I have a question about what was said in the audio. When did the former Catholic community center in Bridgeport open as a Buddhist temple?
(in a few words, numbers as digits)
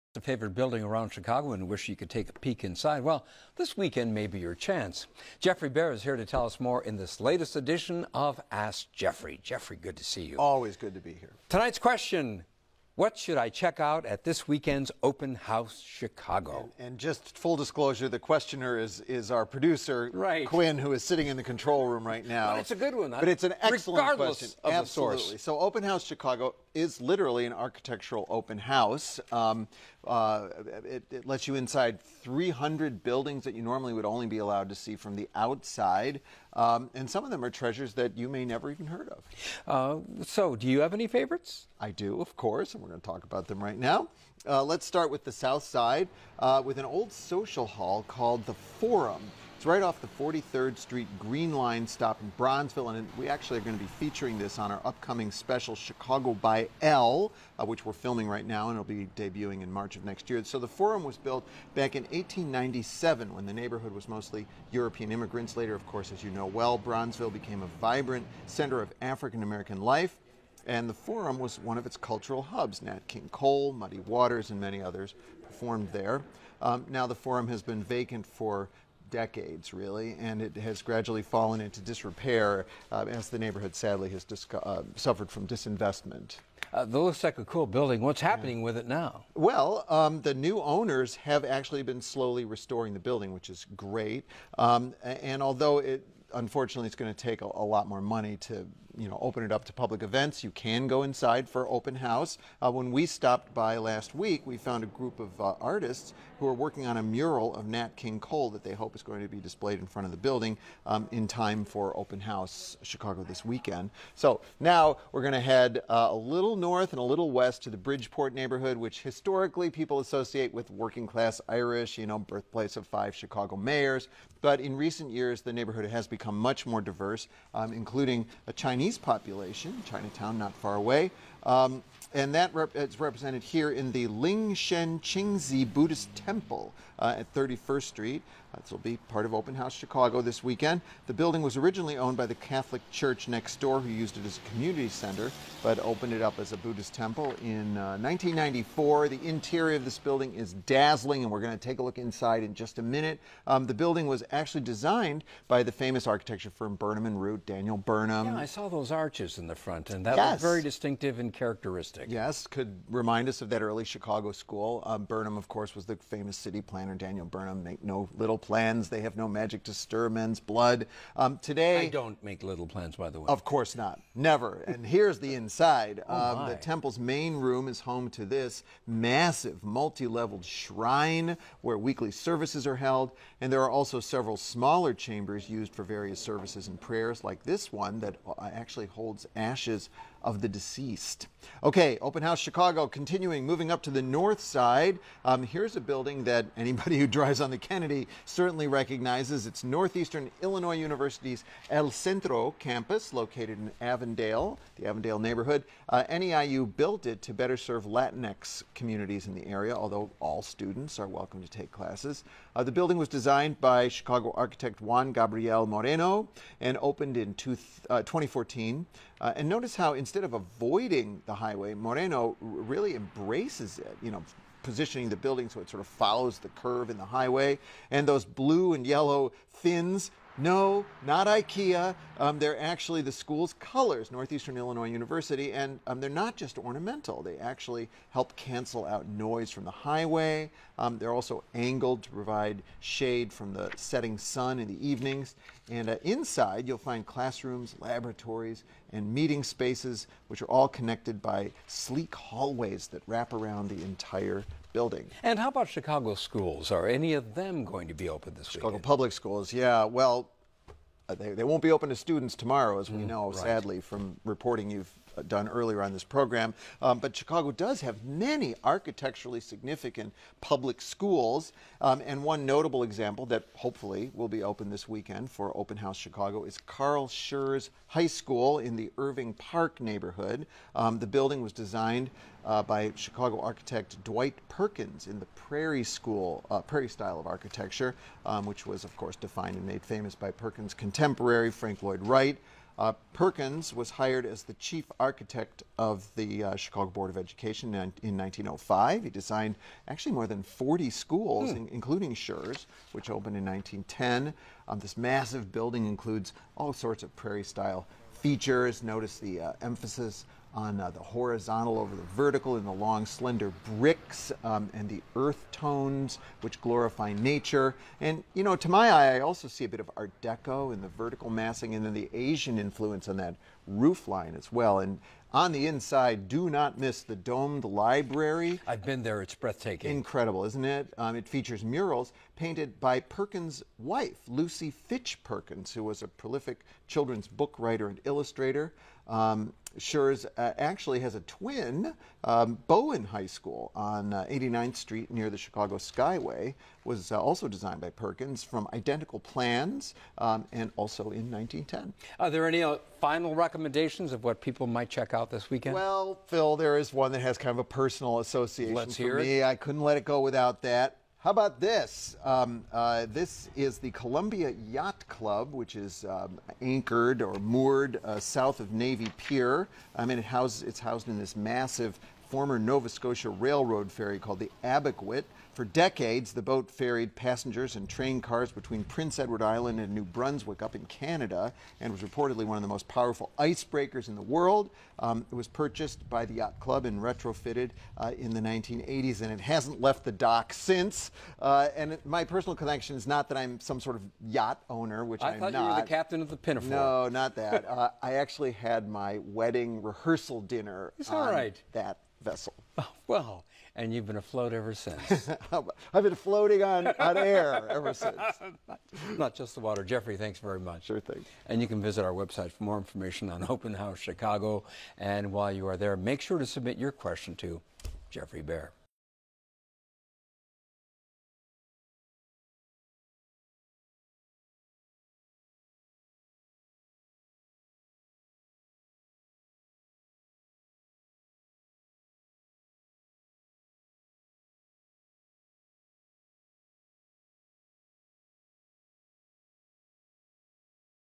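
1994.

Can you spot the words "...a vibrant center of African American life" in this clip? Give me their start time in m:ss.
1:07.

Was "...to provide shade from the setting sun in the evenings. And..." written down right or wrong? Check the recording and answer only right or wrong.
right.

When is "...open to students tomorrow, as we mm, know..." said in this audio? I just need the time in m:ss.
4:21.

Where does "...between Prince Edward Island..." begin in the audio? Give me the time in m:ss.
6:18.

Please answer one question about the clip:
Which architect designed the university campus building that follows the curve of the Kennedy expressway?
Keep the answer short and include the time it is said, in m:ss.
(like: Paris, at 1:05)
Juan Gabriel Moreno, at 3:34.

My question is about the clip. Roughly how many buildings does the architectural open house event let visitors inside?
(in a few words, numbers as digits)
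300.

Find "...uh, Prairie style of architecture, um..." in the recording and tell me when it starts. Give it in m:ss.
4:46.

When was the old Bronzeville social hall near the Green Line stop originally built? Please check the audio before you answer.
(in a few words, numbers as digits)
1897.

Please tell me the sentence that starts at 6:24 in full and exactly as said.
Um, it was purchased by the Yacht Club and retrofitted uh, in the 1980s, and it hasn't left the dock since.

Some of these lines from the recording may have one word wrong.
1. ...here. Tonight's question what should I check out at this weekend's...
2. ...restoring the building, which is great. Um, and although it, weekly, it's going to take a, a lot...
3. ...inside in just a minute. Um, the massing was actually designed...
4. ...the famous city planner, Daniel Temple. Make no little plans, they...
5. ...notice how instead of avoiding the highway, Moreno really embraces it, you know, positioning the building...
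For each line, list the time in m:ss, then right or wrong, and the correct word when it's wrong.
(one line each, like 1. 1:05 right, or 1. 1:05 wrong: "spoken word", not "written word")
1. 0:11 right
2. 1:32 wrong: "unfortunately", not "weekly"
3. 2:31 wrong: "building", not "massing"
4. 2:45 wrong: "Burnham", not "Temple"
5. 3:39 right.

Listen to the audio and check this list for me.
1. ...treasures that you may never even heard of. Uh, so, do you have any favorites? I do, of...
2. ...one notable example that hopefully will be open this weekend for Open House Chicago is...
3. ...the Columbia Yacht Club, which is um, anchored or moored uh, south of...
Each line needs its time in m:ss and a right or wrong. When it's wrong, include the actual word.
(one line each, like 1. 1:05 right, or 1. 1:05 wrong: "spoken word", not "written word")
1. 0:37 right
2. 4:32 right
3. 6:03 right.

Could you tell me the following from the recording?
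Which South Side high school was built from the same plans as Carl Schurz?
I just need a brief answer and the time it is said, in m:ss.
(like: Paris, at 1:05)
Bowen High School, at 5:42.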